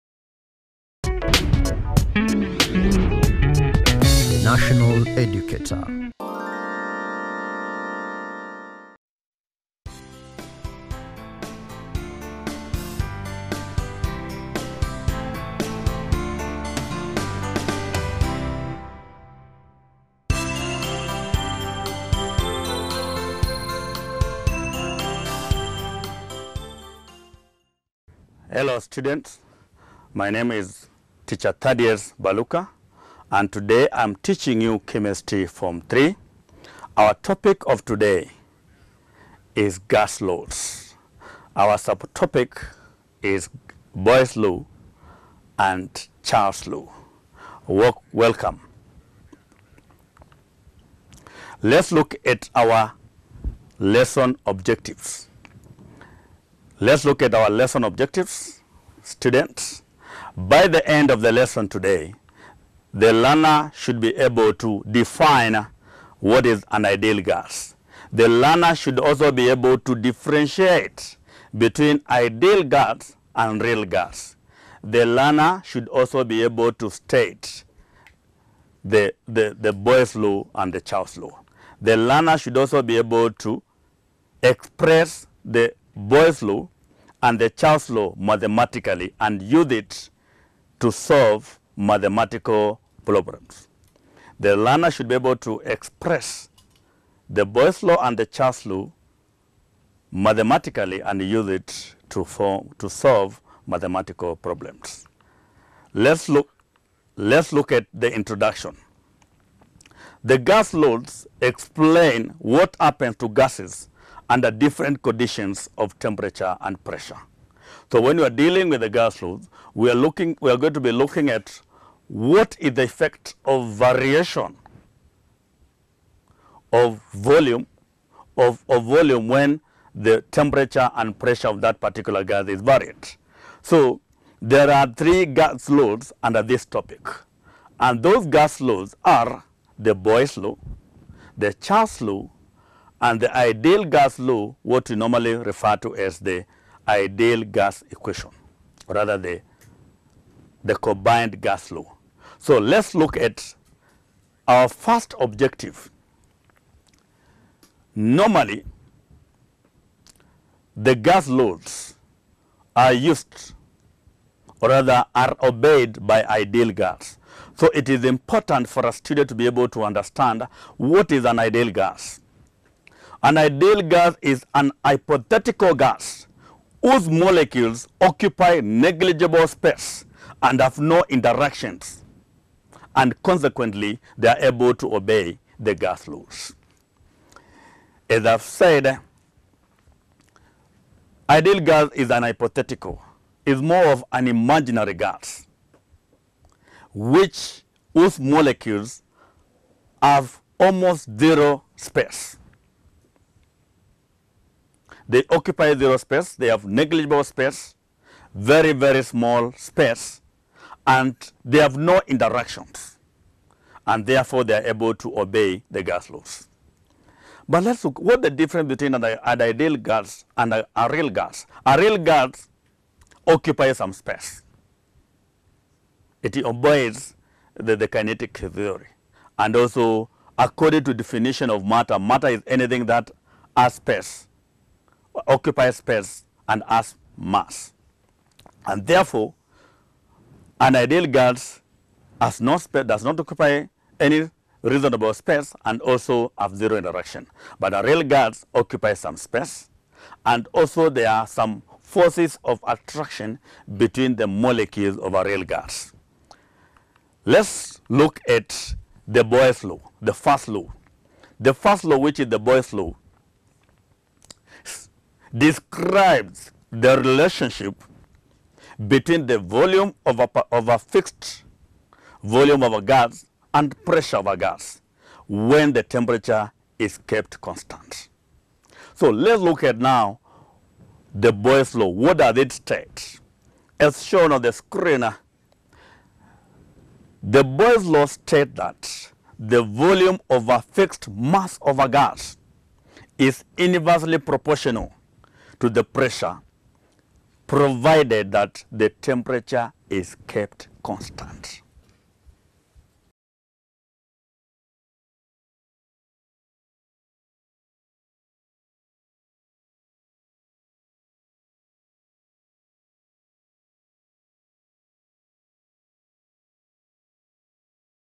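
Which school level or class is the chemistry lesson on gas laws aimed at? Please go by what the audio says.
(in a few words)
Form 3.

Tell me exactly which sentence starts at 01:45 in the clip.
Let's look, let's look at the introduction.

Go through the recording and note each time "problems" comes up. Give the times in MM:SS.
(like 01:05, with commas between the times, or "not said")
01:33, 01:44.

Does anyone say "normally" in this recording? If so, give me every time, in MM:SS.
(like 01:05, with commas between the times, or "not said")
02:24, 02:37.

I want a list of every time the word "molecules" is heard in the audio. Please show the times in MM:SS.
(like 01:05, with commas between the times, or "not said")
02:57, 03:18, 04:14.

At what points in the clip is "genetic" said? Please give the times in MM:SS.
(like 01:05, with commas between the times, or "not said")
not said.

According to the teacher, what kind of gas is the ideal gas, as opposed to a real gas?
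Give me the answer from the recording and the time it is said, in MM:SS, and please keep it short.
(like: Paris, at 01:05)
Imaginary, at 03:14.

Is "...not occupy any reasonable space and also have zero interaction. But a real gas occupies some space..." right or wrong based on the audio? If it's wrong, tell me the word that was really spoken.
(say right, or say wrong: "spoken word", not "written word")
right.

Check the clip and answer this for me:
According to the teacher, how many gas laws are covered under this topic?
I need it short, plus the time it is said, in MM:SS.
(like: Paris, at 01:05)
3, at 02:14.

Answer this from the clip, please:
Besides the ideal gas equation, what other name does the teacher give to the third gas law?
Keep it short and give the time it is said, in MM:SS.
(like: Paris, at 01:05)
Combined gas law, at 02:30.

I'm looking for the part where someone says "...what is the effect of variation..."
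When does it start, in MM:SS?
02:02.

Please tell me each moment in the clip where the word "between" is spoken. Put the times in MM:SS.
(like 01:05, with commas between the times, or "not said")
01:11, 03:38, 04:13, 04:28.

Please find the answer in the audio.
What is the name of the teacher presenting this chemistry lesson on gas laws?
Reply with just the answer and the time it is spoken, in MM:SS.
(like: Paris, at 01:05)
Thaddeus Baluka, at 00:31.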